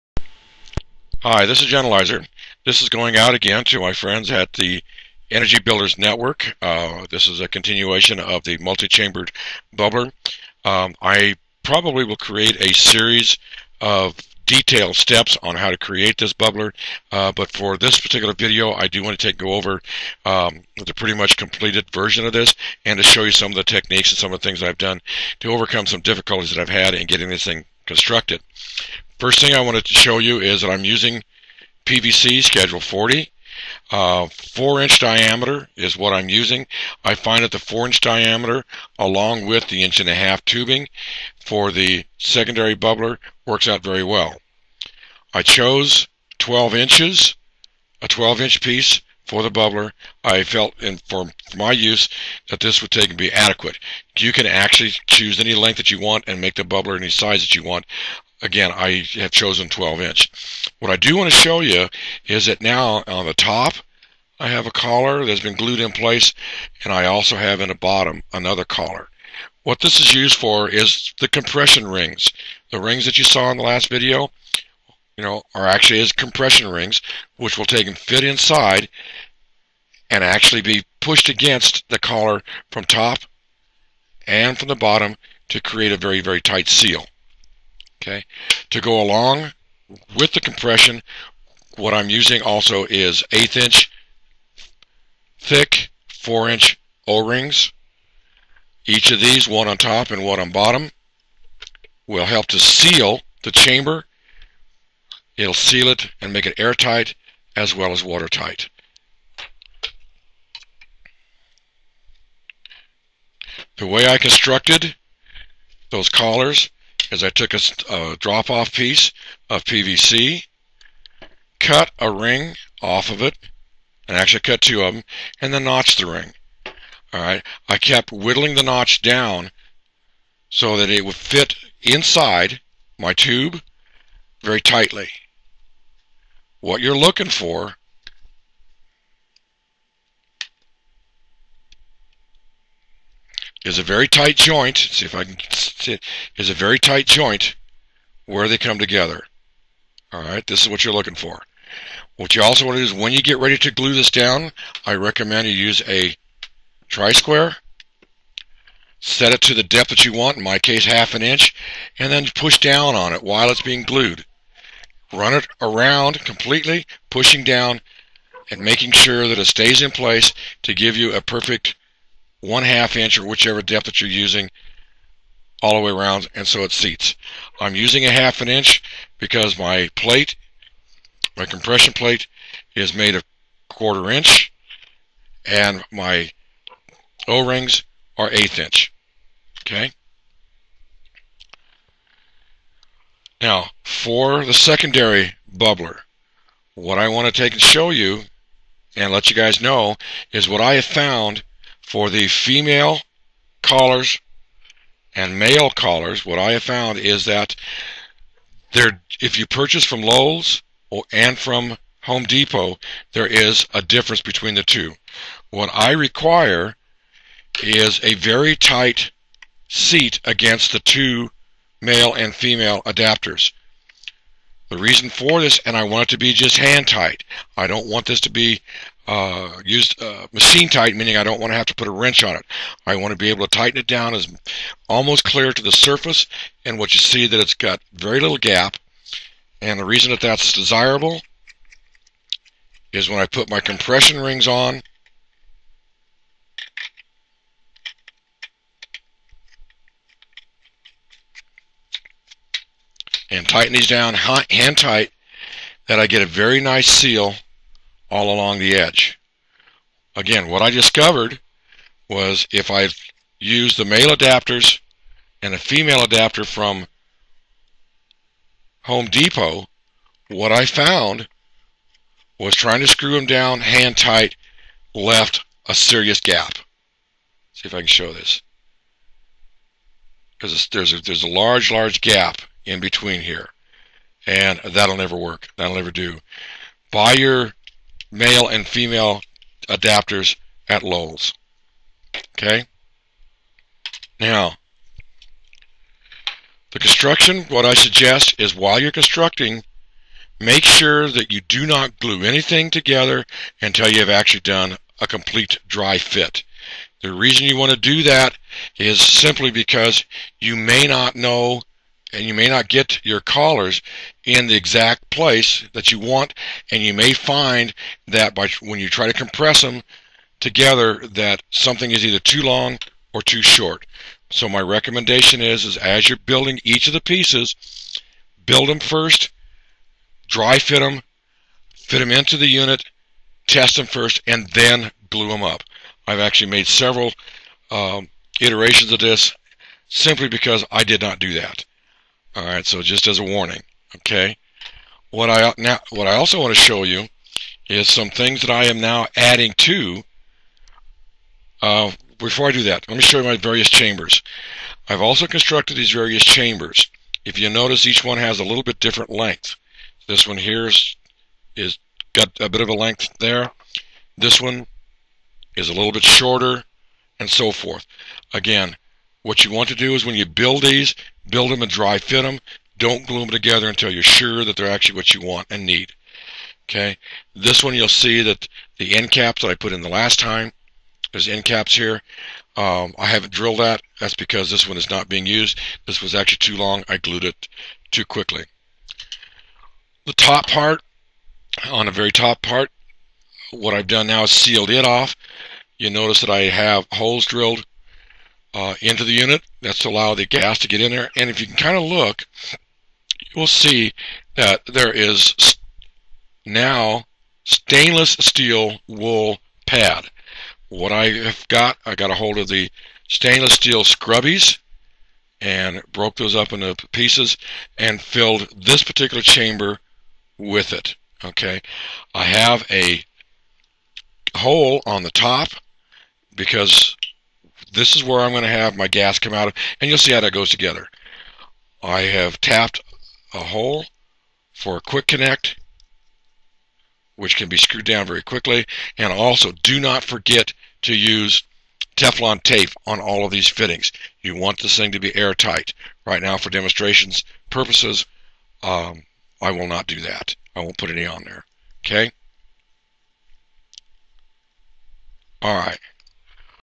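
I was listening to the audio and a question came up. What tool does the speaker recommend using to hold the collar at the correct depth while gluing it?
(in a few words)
tri-square.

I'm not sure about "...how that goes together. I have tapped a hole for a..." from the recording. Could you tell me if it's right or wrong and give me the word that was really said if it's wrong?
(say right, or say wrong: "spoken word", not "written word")
right.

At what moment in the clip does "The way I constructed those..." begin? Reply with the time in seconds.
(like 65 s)
113 s.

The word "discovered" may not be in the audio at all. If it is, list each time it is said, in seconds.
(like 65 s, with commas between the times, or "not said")
260 s.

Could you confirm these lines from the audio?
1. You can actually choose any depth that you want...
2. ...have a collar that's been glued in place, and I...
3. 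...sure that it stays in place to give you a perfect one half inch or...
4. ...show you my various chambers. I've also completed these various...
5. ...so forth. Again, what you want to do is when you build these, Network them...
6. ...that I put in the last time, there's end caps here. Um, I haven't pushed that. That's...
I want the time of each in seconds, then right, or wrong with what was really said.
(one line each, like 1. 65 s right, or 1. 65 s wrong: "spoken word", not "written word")
1. 54 s wrong: "length", not "depth"
2. 64 s right
3. 168 s right
4. 353 s wrong: "constructed", not "completed"
5. 367 s wrong: "Build", not "Network"
6. 379 s wrong: "drilled", not "pushed".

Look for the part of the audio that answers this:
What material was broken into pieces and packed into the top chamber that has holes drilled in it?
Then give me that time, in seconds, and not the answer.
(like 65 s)
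413 s.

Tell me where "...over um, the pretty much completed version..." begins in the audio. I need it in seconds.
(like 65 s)
19 s.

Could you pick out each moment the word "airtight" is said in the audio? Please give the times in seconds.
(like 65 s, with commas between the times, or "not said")
106 s, 445 s.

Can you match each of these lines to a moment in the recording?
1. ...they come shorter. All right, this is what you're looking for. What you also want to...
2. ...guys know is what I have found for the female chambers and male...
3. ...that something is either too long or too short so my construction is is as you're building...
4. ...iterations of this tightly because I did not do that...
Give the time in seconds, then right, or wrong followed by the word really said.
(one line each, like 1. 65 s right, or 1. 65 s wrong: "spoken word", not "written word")
1. 148 s wrong: "together", not "shorter"
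2. 199 s wrong: "callers", not "chambers"
3. 321 s wrong: "recommendation", not "construction"
4. 338 s wrong: "simply", not "tightly".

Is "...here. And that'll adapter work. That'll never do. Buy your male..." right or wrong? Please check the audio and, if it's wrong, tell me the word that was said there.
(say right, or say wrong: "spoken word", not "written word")
wrong: "never", not "adapter".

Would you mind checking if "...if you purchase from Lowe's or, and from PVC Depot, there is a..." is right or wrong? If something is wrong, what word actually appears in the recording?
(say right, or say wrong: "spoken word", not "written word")
wrong: "Home", not "PVC".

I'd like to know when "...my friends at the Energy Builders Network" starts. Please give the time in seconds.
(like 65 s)
3 s.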